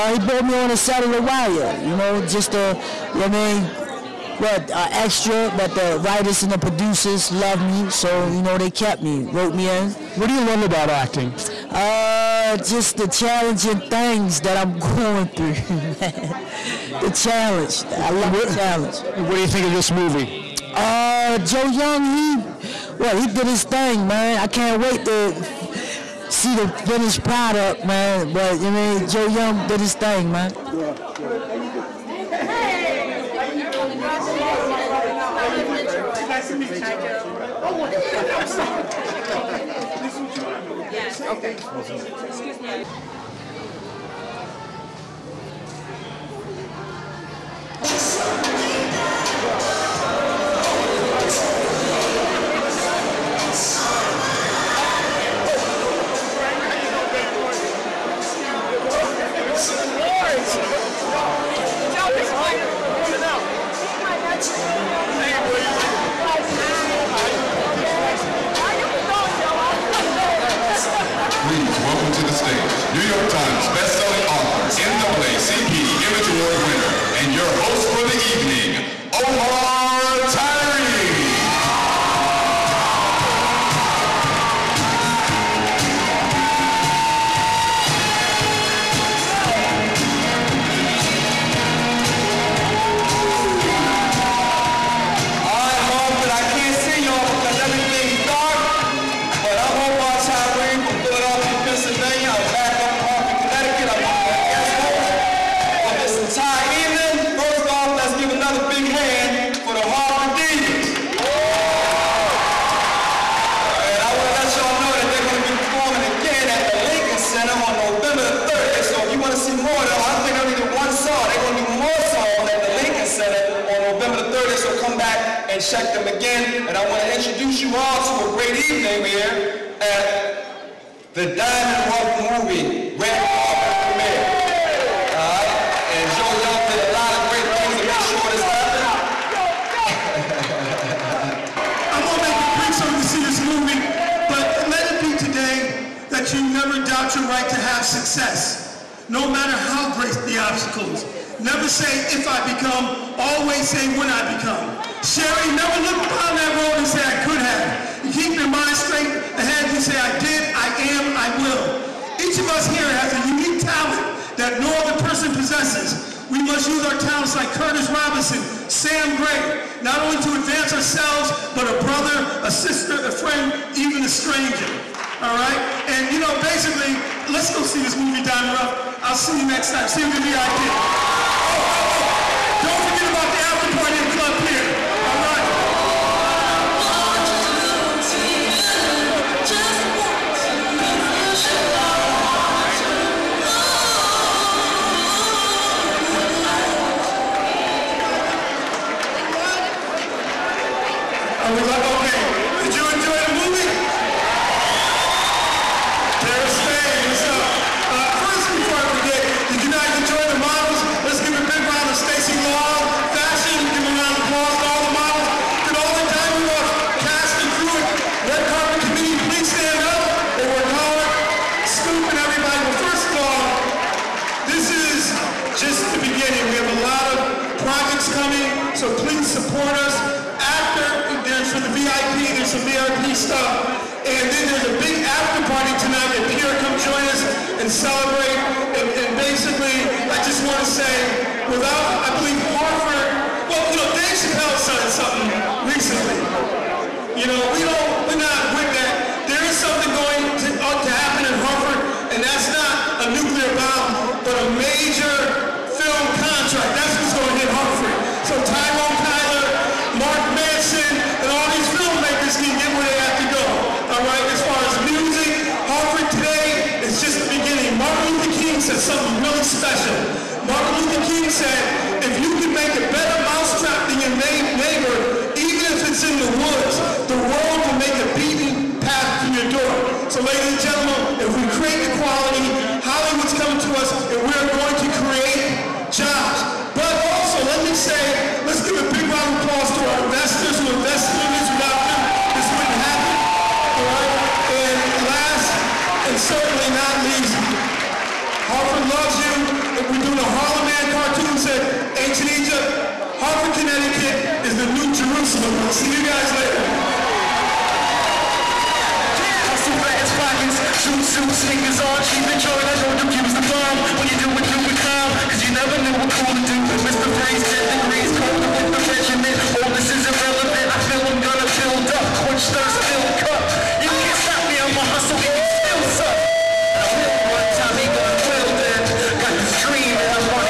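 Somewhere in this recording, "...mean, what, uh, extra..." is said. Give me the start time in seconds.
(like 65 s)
3 s.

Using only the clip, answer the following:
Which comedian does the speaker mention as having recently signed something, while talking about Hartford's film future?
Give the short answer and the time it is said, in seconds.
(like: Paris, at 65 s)
Dave Chappelle, at 243 s.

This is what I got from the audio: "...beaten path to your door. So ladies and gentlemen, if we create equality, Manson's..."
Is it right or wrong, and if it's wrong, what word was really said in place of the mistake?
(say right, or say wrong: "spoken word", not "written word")
wrong: "Hollywood", not "Manson".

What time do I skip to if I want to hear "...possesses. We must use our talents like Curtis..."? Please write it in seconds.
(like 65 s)
165 s.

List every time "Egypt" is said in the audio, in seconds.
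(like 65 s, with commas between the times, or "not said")
302 s.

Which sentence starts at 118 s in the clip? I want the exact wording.
So if you want to see more of them, I think they only did one song.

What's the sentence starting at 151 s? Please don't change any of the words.
Never say, if I become, always say, when I become.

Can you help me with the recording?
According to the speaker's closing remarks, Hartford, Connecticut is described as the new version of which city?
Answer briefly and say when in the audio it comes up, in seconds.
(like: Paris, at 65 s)
Jerusalem, at 304 s.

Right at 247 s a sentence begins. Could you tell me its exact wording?
You know, we don't, we're not with that.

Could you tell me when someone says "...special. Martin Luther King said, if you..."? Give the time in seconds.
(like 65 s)
269 s.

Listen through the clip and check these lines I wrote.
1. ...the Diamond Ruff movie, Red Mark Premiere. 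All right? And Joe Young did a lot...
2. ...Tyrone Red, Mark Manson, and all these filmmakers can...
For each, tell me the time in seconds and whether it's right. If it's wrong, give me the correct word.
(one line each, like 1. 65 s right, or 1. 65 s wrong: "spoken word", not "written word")
1. 131 s wrong: "Carpet", not "Mark"
2. 258 s wrong: "Kyler", not "Red".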